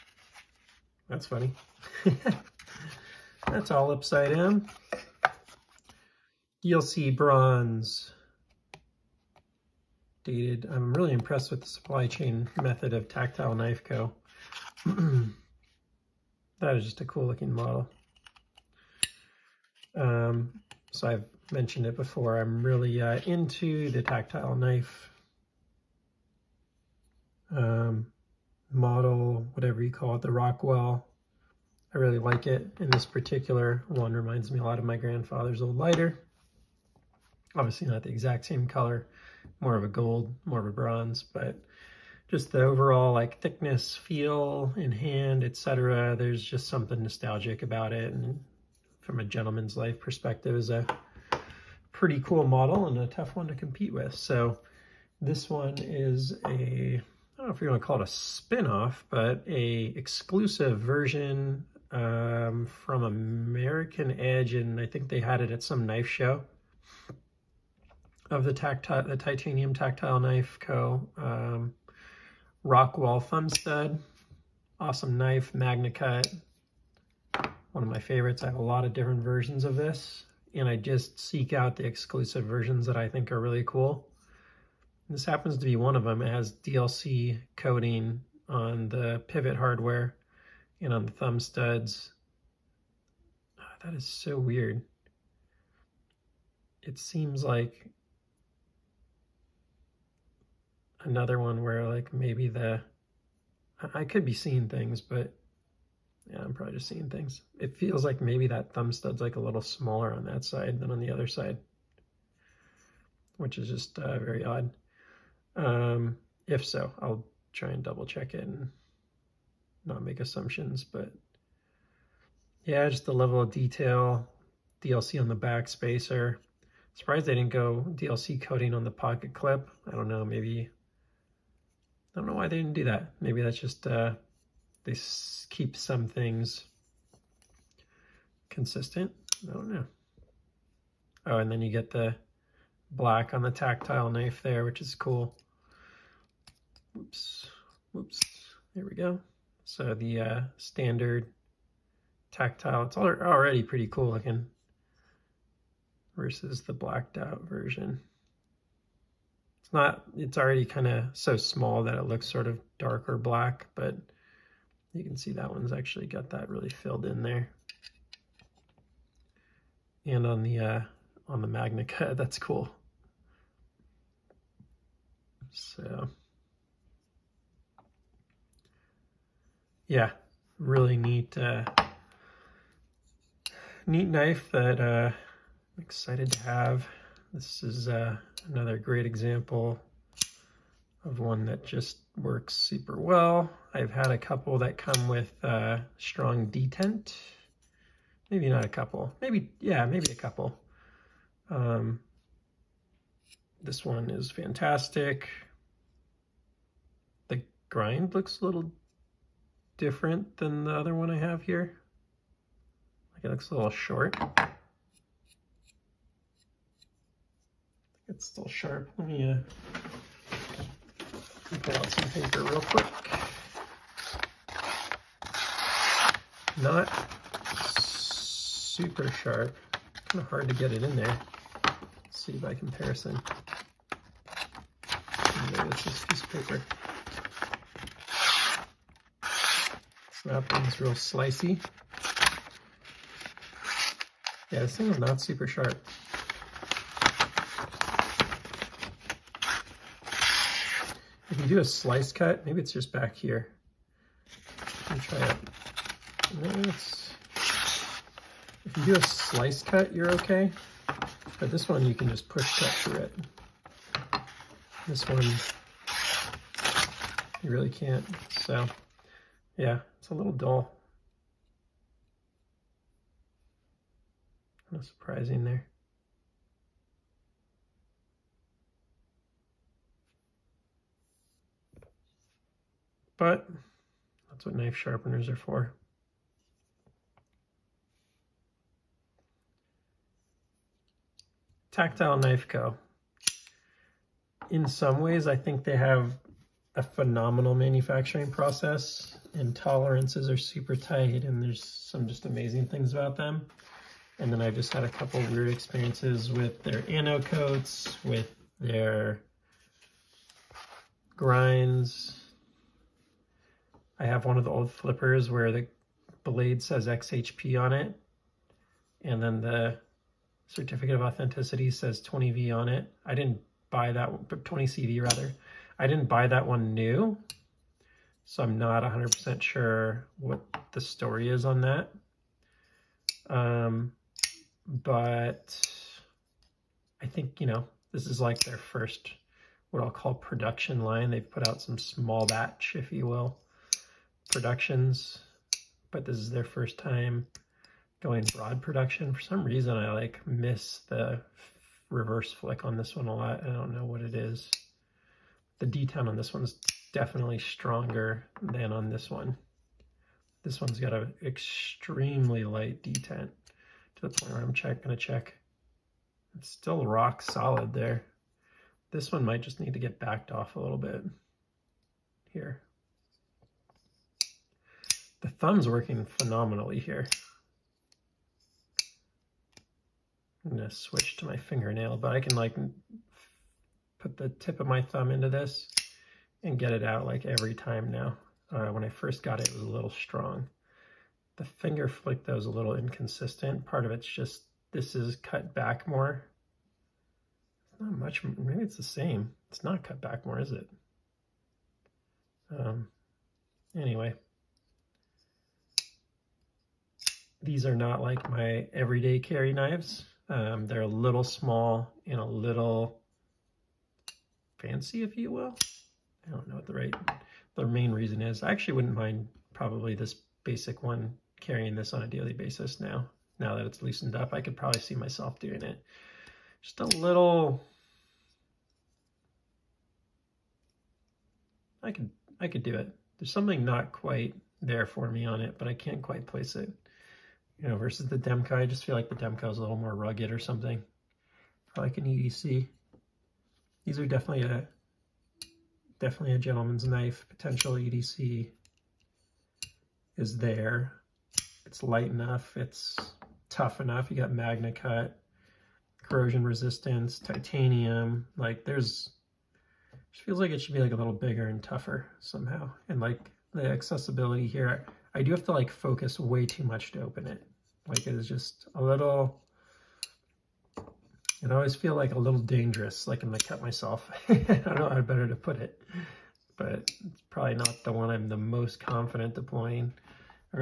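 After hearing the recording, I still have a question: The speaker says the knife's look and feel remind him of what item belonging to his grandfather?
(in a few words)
lighter.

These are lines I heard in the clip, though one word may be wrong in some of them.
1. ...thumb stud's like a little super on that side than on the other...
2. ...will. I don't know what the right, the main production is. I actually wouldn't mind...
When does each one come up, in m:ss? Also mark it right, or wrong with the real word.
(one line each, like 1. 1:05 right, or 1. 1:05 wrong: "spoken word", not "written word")
1. 1:48 wrong: "smaller", not "super"
2. 6:55 wrong: "reason", not "production".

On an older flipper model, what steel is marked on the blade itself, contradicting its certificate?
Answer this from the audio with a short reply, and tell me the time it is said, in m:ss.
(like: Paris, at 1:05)
XHP, at 5:16.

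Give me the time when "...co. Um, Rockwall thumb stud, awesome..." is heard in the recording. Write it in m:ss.
1:10.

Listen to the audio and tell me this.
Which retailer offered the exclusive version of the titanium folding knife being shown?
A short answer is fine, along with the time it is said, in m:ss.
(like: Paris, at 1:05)
American Edge, at 1:03.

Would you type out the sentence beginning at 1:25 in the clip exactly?
This happens to be one of them.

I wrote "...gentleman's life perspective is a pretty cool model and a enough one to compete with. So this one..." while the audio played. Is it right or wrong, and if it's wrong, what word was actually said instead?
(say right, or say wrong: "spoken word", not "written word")
wrong: "tough", not "enough".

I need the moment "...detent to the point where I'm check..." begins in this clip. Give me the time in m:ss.
6:02.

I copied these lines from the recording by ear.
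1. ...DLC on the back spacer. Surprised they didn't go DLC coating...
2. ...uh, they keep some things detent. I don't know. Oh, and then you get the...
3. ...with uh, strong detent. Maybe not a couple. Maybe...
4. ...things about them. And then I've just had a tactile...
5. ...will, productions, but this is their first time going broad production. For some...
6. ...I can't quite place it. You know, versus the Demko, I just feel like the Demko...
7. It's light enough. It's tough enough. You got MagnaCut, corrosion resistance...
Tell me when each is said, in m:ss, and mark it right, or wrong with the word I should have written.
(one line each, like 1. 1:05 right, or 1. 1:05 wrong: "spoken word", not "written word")
1. 2:04 right
2. 2:13 wrong: "consistent", not "detent"
3. 3:15 right
4. 5:02 wrong: "couple", not "tactile"
5. 5:43 right
6. 7:15 right
7. 7:31 right.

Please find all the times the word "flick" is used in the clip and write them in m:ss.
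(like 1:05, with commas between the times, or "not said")
5:52, 6:31.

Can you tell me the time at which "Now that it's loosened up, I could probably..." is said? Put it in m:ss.
7:03.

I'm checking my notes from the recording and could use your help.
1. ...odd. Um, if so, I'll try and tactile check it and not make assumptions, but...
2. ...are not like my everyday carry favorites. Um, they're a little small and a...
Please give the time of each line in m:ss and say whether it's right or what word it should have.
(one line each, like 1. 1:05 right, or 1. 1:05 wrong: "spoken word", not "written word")
1. 1:54 wrong: "double", not "tactile"
2. 6:47 wrong: "knives", not "favorites".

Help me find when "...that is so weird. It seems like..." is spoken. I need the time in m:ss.
1:33.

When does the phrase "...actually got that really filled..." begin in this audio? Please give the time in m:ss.
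2:45.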